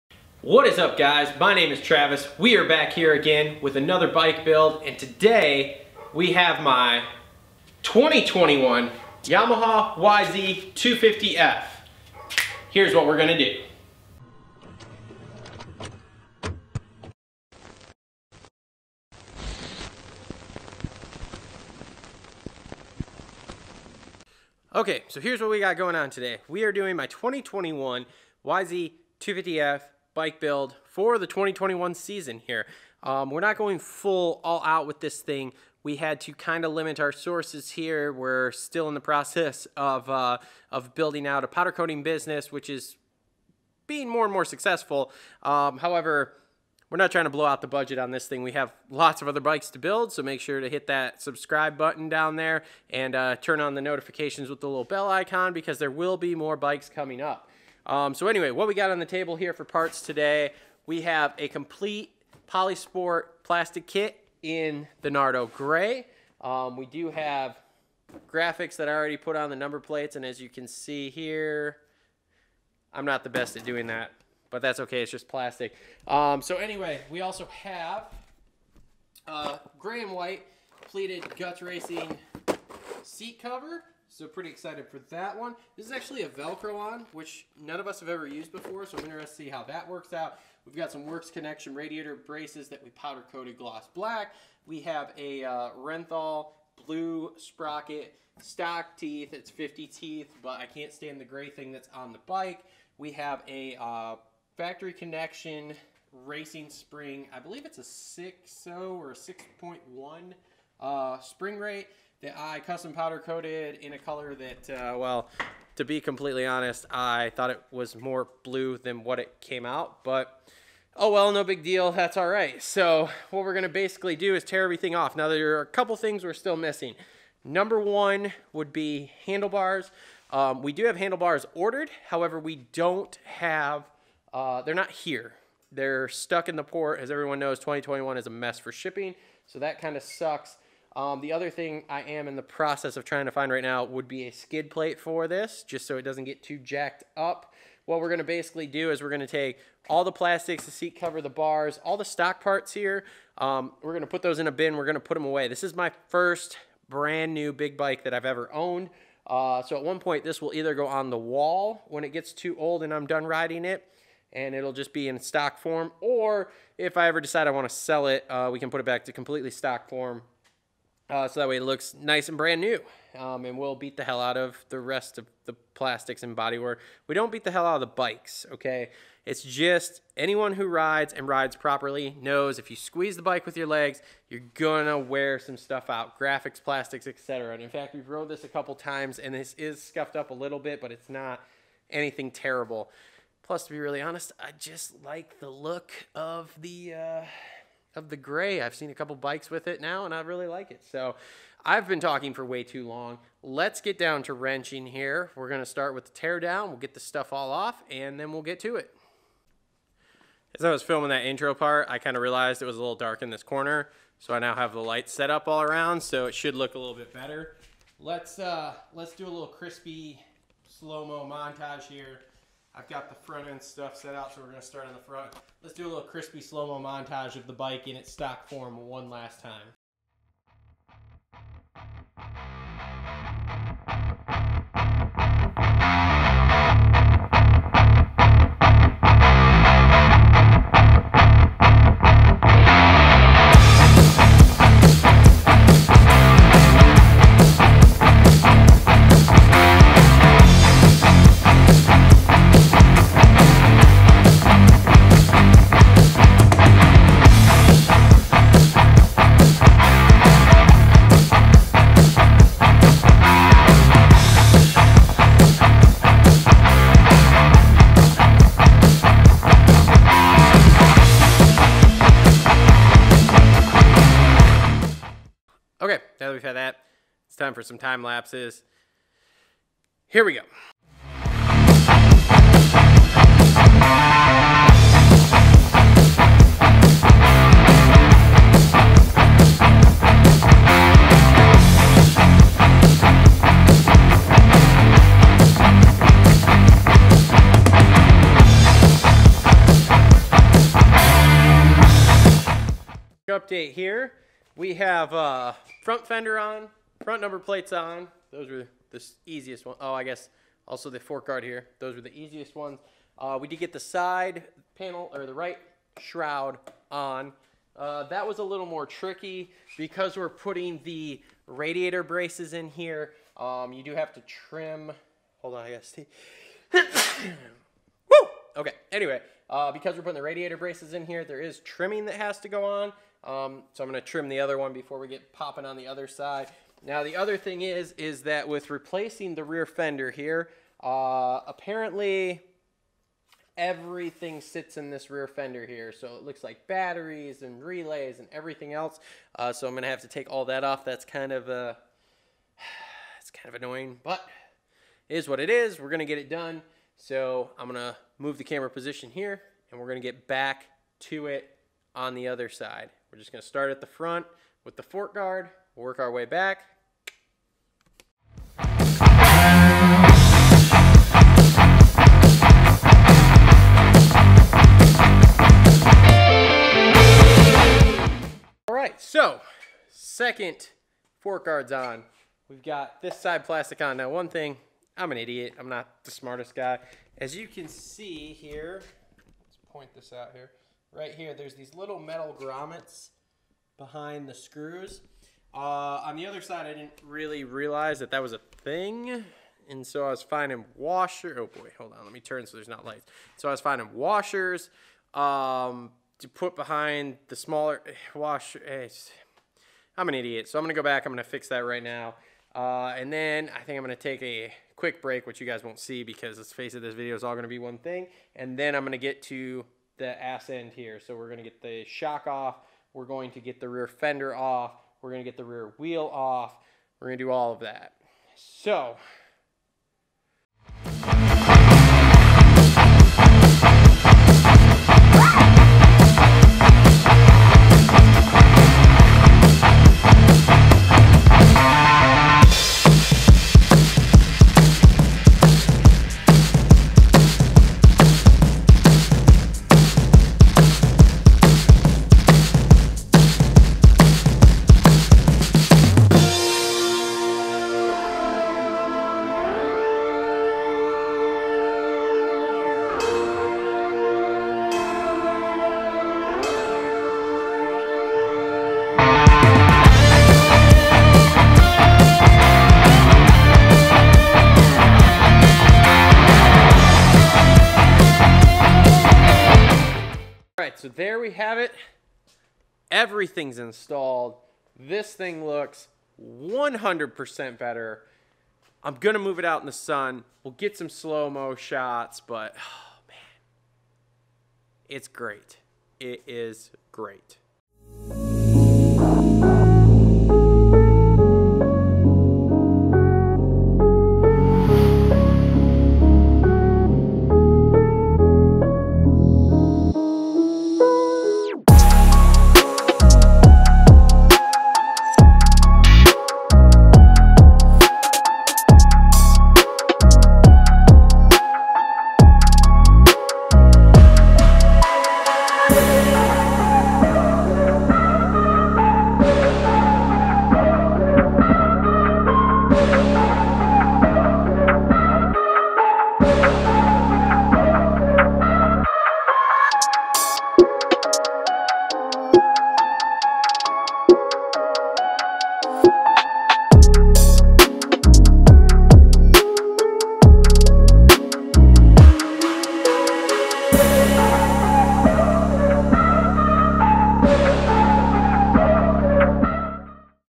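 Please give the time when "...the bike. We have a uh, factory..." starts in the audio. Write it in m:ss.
1:42.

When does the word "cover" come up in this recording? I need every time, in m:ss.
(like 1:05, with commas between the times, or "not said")
1:23, 2:30.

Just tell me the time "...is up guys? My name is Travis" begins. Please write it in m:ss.
0:00.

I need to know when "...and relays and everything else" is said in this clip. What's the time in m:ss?
5:47.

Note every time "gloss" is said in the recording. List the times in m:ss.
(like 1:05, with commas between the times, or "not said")
1:33.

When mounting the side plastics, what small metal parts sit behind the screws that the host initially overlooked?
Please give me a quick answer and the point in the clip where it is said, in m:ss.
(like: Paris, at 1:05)
metal grommets, at 6:31.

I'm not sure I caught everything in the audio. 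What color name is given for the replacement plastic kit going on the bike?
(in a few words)
Nardo gray.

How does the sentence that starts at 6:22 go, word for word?
We've got this side plastic on.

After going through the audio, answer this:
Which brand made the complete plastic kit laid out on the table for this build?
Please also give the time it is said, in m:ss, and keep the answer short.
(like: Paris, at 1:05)
Polisport, at 1:02.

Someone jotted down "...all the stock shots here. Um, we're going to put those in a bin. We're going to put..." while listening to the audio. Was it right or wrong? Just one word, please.
wrong.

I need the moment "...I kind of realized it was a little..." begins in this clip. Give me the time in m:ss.
3:31.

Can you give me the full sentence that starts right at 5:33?
Um, so I'm gonna trim the other one before we get popping on the other side.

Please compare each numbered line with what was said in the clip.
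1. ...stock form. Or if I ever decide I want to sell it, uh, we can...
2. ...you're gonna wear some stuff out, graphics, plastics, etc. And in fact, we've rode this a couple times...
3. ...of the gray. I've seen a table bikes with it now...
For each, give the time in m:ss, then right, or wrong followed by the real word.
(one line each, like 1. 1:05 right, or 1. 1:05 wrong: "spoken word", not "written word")
1. 2:45 right
2. 3:04 right
3. 3:17 wrong: "couple", not "table".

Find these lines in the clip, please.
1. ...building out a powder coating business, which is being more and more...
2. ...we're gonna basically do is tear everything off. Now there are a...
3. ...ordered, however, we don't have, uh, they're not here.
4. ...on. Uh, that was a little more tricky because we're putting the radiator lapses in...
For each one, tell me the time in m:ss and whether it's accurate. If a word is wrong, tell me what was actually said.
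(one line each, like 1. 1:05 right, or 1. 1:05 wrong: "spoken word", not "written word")
1. 0:40 right
2. 2:03 right
3. 2:11 right
4. 5:16 wrong: "braces", not "lapses".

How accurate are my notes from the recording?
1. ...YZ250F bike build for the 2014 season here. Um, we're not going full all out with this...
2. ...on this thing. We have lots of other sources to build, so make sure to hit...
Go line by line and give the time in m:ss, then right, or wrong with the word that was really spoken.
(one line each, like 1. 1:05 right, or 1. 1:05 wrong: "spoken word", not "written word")
1. 0:28 wrong: "2021", not "2014"
2. 0:47 wrong: "bikes", not "sources".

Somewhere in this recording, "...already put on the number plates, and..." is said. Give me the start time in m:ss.
1:08.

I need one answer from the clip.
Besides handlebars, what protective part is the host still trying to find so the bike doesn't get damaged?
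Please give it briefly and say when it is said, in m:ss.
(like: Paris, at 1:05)
skid plate, at 2:24.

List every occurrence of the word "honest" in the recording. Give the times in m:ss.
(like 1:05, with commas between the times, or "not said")
1:56, 3:14.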